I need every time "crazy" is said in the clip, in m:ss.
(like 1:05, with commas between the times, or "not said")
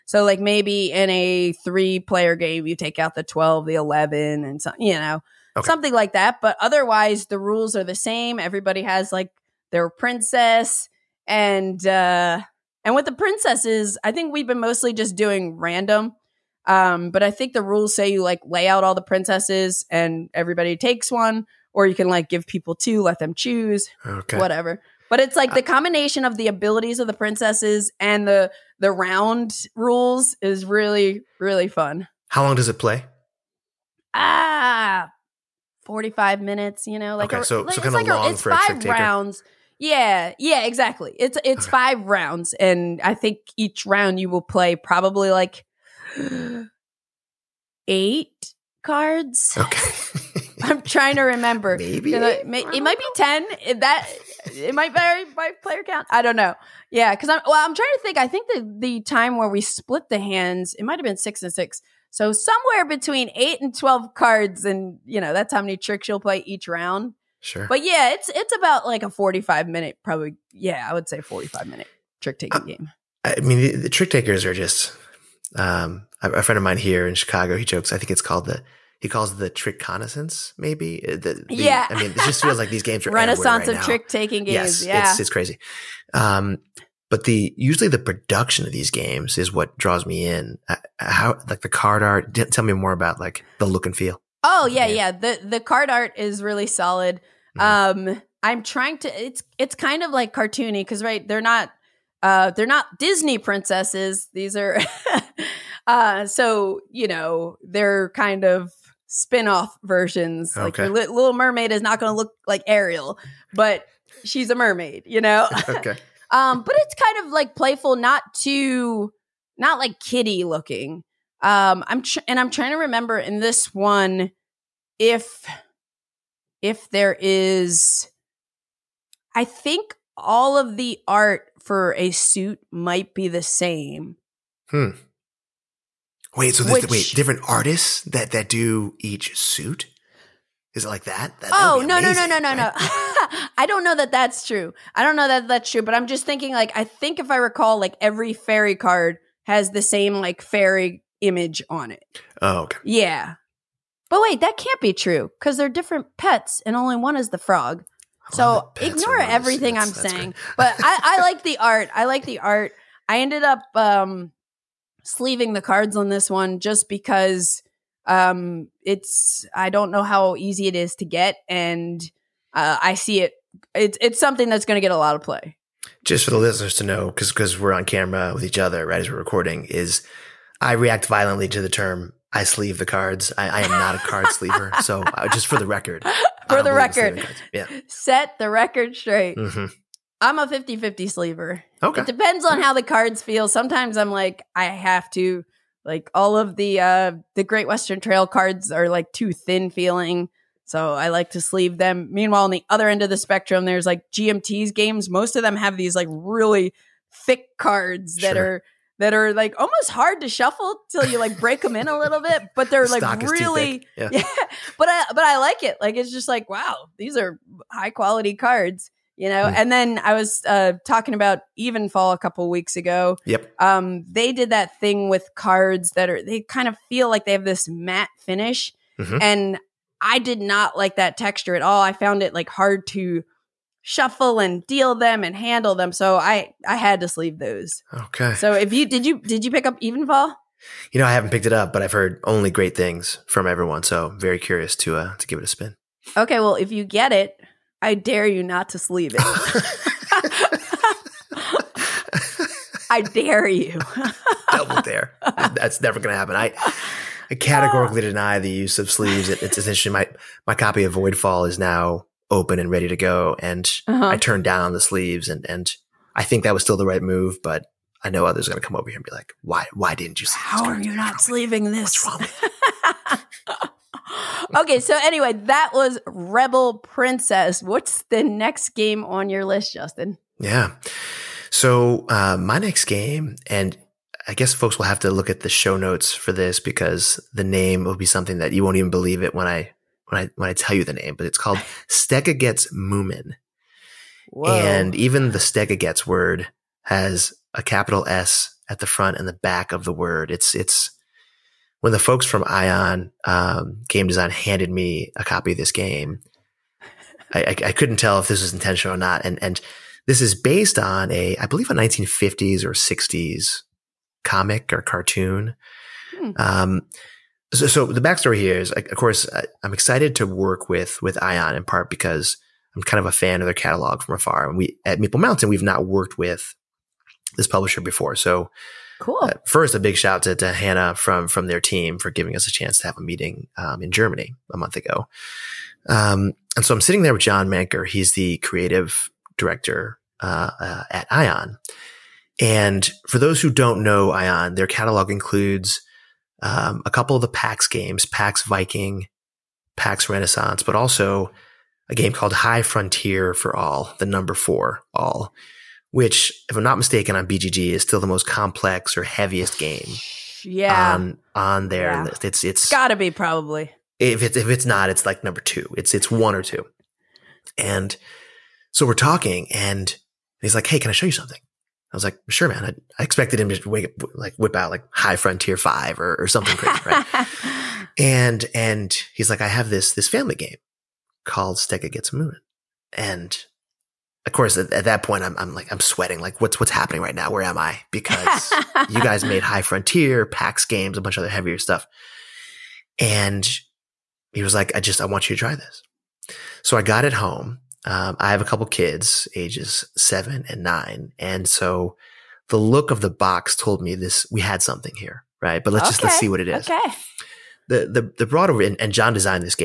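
1:25, 6:16.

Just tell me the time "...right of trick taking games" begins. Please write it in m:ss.
1:23.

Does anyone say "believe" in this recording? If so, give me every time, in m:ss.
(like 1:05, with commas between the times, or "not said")
4:48, 5:11.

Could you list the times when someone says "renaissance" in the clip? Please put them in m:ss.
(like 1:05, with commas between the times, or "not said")
1:23, 5:50.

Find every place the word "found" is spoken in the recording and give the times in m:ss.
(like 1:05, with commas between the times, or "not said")
3:51.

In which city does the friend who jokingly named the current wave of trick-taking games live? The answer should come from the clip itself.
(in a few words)
Chicago.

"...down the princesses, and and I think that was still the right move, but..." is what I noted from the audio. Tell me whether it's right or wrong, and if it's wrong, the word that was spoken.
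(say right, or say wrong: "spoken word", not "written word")
wrong: "sleeves", not "princesses".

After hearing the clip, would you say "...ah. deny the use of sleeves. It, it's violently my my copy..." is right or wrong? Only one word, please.
wrong.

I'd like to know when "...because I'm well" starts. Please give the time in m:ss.
0:57.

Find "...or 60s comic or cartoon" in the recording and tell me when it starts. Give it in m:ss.
5:12.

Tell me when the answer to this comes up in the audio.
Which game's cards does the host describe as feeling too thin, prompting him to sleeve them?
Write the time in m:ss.
3:17.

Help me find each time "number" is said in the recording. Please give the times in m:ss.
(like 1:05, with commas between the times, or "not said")
5:54, 6:05.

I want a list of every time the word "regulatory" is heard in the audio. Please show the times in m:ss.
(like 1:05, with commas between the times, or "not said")
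not said.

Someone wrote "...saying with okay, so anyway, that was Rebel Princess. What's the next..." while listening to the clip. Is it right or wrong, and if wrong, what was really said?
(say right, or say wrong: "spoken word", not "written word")
wrong: "wrong", not "saying".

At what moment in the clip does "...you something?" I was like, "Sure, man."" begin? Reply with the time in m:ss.
6:11.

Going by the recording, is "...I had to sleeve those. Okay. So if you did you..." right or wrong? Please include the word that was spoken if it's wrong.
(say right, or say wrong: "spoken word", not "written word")
right.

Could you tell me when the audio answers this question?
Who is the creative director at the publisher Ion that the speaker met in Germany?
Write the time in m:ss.
5:37.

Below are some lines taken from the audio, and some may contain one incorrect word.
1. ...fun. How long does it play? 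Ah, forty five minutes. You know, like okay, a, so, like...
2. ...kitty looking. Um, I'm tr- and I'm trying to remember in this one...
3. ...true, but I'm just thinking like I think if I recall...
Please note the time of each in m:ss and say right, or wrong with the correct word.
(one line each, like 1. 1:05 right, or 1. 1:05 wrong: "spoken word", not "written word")
1. 0:31 right
2. 1:59 right
3. 2:25 right.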